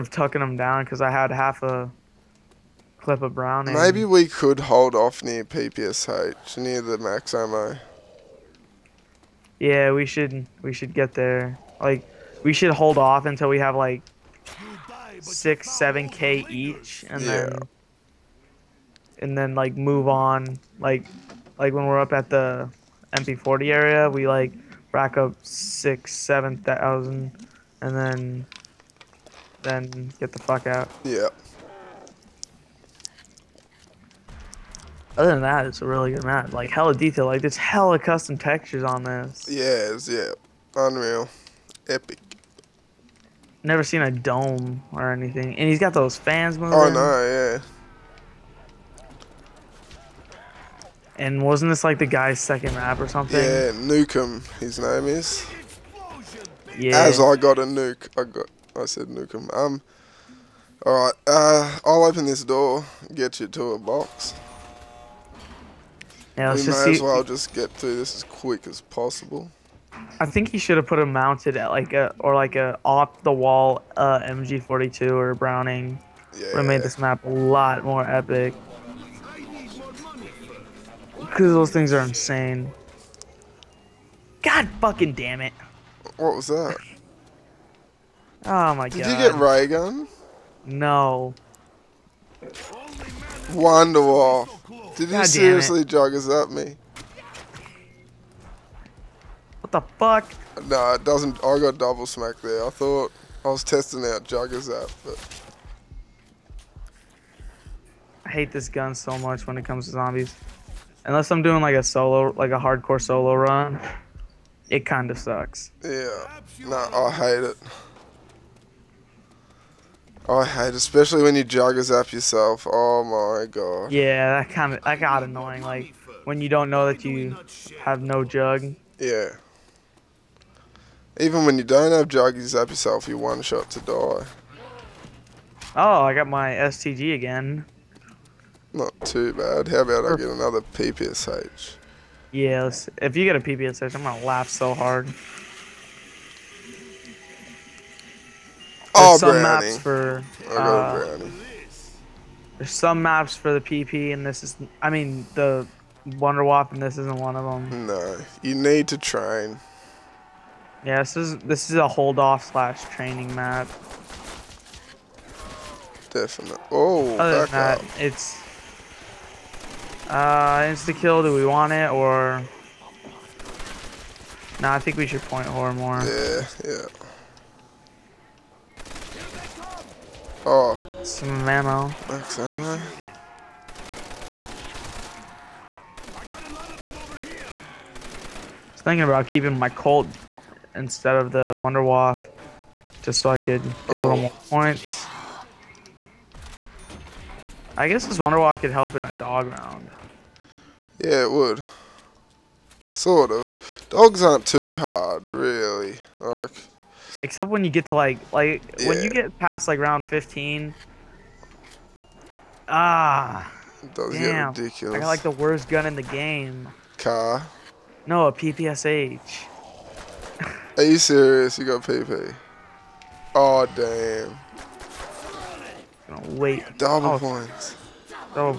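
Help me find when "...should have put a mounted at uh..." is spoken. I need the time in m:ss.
1:10.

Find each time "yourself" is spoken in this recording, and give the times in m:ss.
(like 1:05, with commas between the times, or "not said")
2:02, 2:12.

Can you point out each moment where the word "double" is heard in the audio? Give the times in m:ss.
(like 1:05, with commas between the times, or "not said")
1:41, 3:46.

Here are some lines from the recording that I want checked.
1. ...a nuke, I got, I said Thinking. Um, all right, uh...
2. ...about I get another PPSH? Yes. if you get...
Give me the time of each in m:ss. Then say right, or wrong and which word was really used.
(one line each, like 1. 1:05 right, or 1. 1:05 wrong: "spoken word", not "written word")
1. 0:57 wrong: "Nukem", not "Thinking"
2. 2:19 right.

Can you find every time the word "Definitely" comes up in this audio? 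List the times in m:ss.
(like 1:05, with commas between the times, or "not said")
2:46.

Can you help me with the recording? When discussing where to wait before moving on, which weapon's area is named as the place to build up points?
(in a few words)
MP40.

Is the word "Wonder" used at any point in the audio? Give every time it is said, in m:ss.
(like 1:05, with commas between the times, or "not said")
1:33, 2:36, 3:11, 3:18.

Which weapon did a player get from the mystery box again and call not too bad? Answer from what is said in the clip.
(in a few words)
STG.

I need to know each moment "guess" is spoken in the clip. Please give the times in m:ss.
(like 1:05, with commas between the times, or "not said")
3:17.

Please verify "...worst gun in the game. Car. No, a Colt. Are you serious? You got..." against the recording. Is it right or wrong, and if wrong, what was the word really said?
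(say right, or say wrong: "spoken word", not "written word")
wrong: "PPSH", not "Colt".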